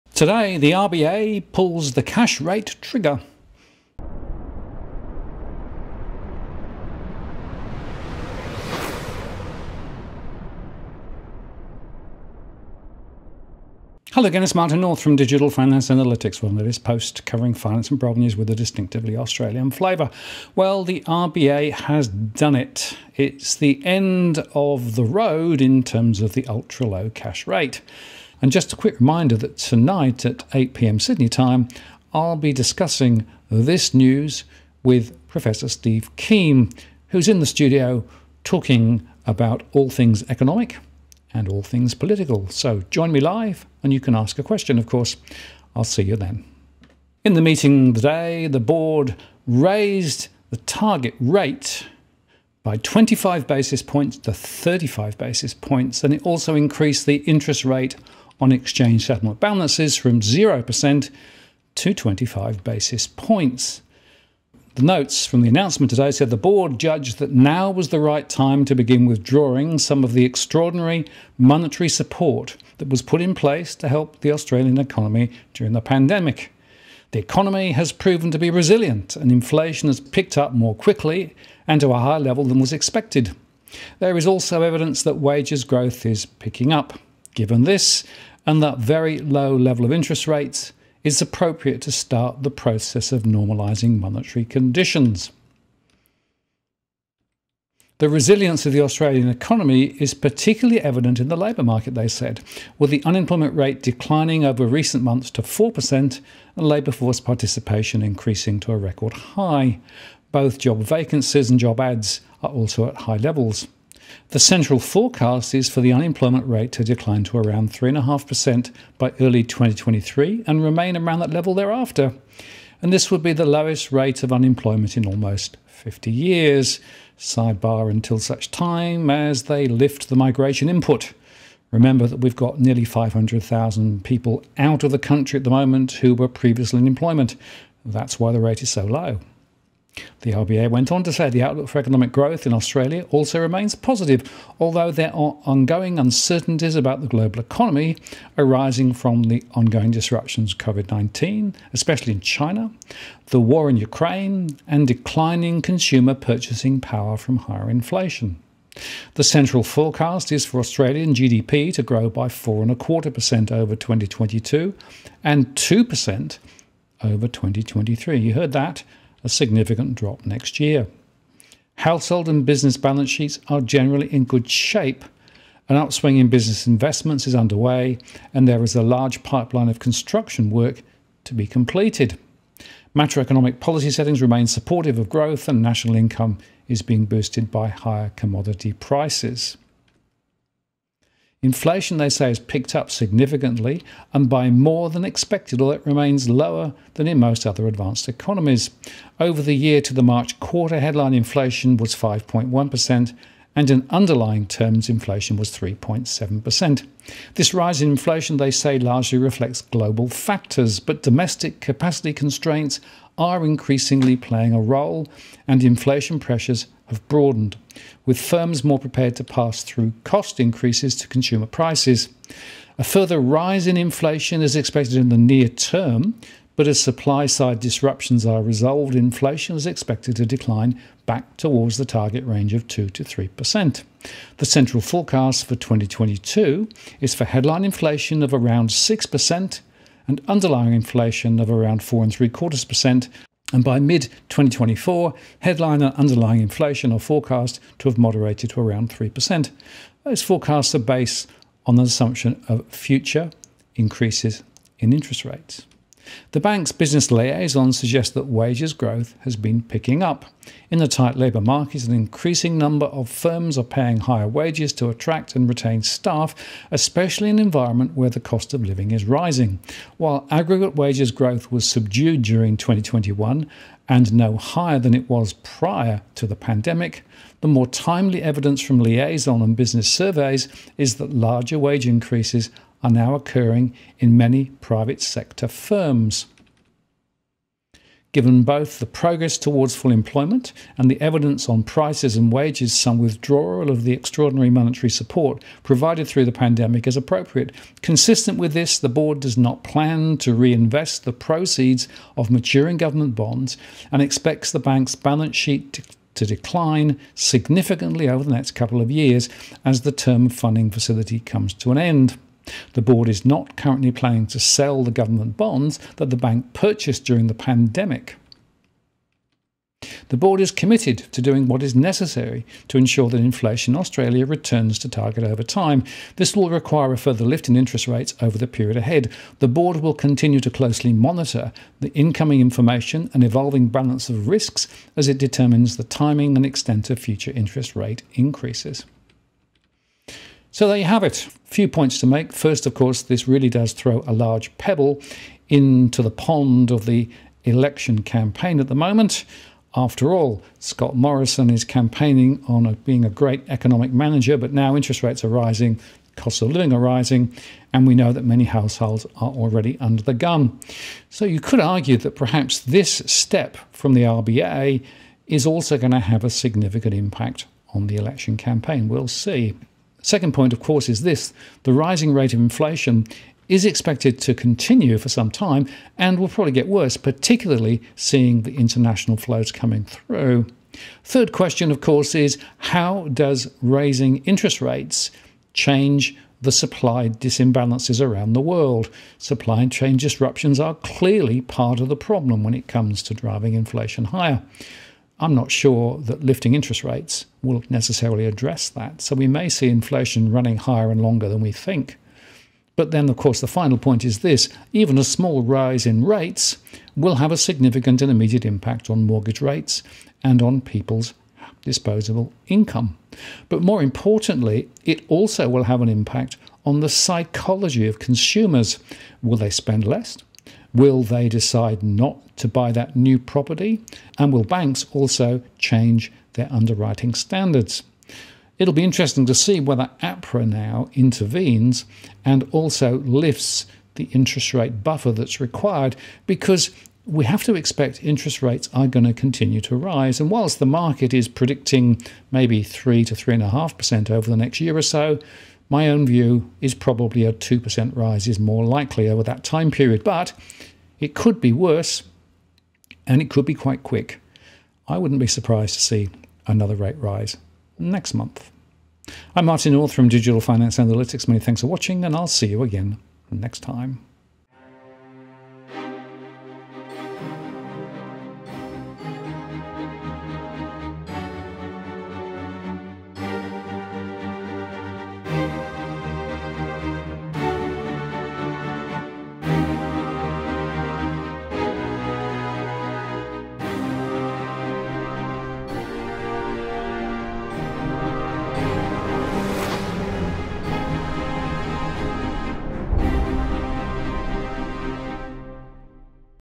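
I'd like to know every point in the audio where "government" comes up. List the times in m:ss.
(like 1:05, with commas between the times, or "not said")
5:02, 5:14.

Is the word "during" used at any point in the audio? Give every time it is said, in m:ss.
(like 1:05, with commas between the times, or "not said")
1:15, 4:32, 5:17.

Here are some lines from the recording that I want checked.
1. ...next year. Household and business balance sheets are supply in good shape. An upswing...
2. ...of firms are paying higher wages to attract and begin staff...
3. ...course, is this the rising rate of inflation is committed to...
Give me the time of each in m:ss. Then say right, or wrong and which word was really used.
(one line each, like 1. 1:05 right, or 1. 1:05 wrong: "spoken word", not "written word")
1. 2:50 wrong: "generally", not "supply"
2. 4:22 wrong: "retain", not "begin"
3. 6:10 wrong: "expected", not "committed".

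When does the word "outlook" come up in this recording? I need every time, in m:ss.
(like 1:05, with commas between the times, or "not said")
2:21.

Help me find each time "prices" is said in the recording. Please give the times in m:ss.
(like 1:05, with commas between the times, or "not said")
3:08, 3:41, 4:51.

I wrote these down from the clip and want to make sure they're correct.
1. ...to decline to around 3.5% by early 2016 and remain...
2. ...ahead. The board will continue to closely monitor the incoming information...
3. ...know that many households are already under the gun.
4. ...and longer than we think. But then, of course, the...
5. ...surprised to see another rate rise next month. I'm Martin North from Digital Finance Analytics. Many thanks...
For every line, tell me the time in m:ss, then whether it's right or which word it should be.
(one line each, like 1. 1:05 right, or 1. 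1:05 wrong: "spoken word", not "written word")
1. 1:56 wrong: "2023", not "2016"
2. 5:28 right
3. 5:57 right
4. 6:40 right
5. 7:35 right.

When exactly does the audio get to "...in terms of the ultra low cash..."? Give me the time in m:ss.
0:25.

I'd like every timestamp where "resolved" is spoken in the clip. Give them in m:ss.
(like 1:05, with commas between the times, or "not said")
3:48.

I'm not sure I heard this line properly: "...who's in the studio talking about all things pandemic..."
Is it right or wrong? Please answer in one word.
wrong.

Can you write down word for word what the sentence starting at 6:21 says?
Third question, of course, is how does raising interest rates change the supply disimbalances around the world.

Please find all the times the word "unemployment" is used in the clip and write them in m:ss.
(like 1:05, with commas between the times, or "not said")
1:43, 1:55, 2:04.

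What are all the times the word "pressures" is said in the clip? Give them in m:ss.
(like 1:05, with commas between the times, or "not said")
3:36.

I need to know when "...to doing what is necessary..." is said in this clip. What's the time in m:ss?
5:21.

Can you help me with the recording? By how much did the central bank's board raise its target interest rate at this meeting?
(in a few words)
35 basis points.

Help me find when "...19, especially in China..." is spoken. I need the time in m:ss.
2:30.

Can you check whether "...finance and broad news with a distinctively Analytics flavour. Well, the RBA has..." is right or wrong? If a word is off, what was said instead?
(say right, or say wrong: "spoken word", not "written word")
wrong: "Australian", not "Analytics".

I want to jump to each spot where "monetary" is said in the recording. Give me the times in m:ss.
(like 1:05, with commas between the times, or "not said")
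1:11, 1:33, 4:54.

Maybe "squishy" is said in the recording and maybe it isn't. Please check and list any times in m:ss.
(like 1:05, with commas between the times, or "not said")
not said.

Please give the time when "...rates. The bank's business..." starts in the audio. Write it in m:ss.
4:15.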